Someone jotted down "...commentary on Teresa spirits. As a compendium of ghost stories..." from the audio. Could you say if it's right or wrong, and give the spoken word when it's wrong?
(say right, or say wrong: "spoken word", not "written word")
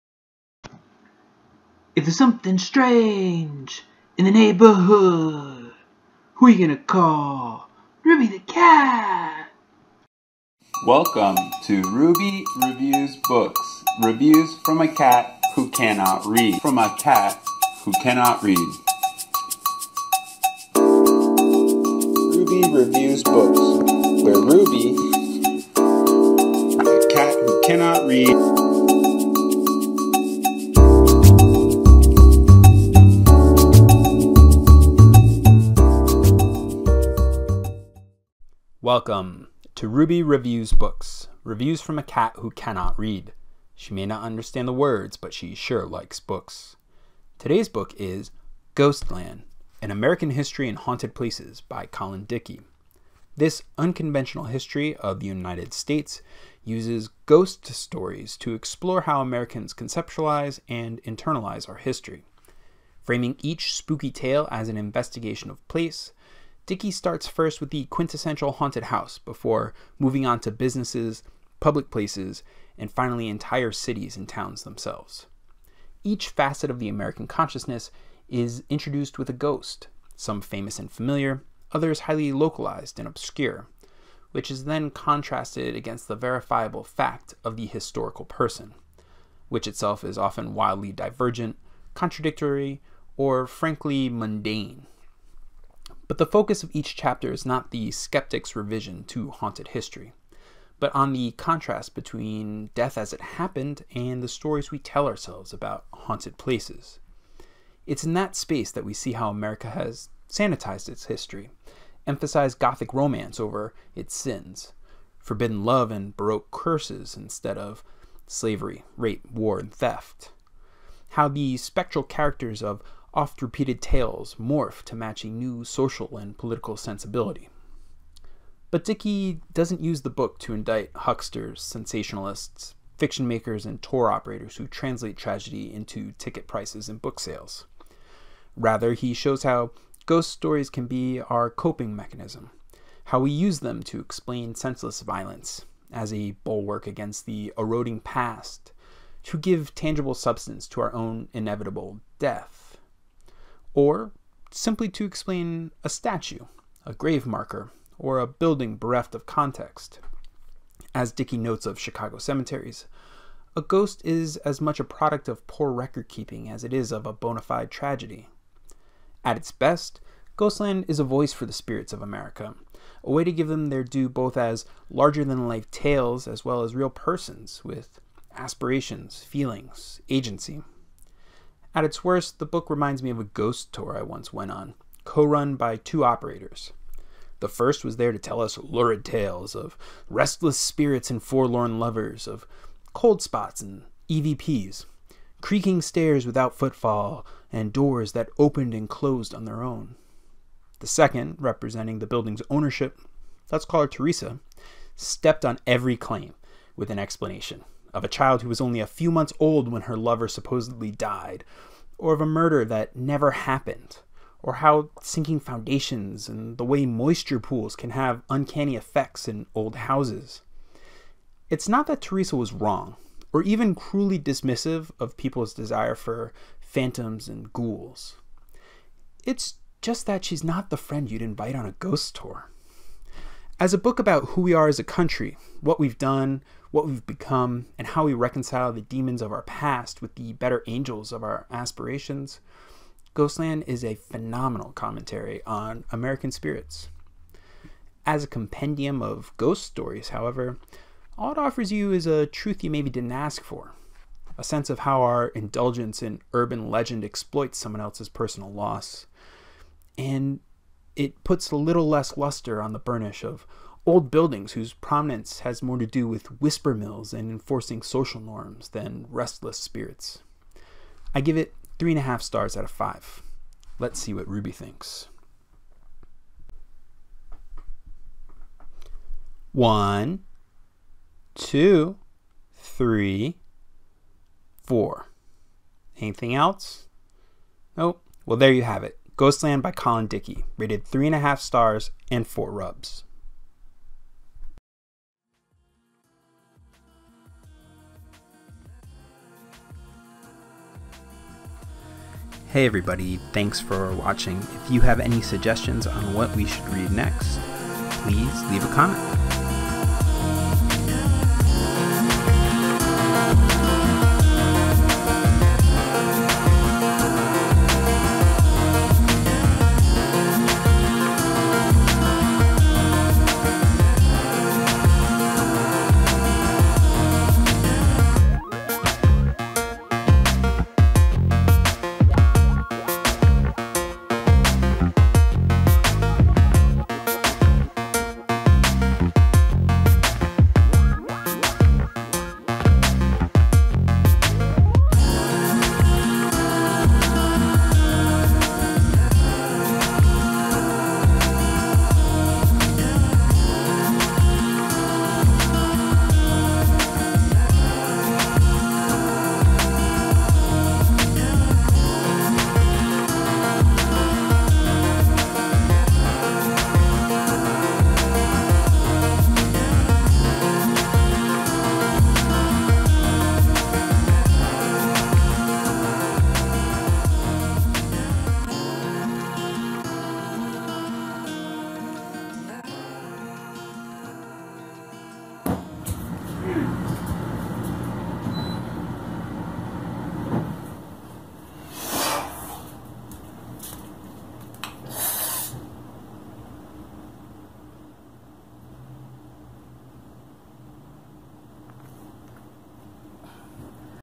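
wrong: "American", not "Teresa".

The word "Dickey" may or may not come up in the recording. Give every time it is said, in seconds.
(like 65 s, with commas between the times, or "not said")
52 s, 66 s, 128 s, 161 s, 290 s.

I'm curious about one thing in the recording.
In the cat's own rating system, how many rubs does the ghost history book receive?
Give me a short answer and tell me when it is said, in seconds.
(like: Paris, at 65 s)
4, at 292 s.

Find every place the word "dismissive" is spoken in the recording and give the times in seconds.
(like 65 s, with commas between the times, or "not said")
224 s.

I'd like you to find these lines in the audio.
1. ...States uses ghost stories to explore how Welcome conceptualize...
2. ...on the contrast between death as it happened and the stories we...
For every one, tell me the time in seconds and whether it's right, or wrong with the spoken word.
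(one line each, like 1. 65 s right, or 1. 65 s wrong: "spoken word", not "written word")
1. 55 s wrong: "Americans", not "Welcome"
2. 100 s right.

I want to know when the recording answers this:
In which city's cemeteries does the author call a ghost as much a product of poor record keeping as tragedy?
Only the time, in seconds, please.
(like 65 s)
161 s.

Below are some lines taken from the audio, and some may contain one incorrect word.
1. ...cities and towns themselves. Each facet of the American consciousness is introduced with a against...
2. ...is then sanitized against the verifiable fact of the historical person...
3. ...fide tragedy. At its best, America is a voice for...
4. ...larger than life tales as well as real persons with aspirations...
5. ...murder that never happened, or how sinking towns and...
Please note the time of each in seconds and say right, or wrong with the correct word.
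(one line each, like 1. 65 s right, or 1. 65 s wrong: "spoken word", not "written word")
1. 73 s wrong: "ghost", not "against"
2. 84 s wrong: "contrasted", not "sanitized"
3. 167 s wrong: "Ghostland", not "America"
4. 174 s right
5. 212 s wrong: "foundations", not "towns".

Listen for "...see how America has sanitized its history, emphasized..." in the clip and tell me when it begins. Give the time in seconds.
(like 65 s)
108 s.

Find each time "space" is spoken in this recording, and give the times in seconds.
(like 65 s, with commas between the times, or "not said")
108 s.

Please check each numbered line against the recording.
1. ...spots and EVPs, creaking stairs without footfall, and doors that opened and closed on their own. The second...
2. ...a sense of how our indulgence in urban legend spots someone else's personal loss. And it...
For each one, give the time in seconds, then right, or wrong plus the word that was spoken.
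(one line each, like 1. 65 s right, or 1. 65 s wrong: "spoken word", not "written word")
1. 193 s right
2. 254 s wrong: "exploits", not "spots".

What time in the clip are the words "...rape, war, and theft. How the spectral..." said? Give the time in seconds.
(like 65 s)
118 s.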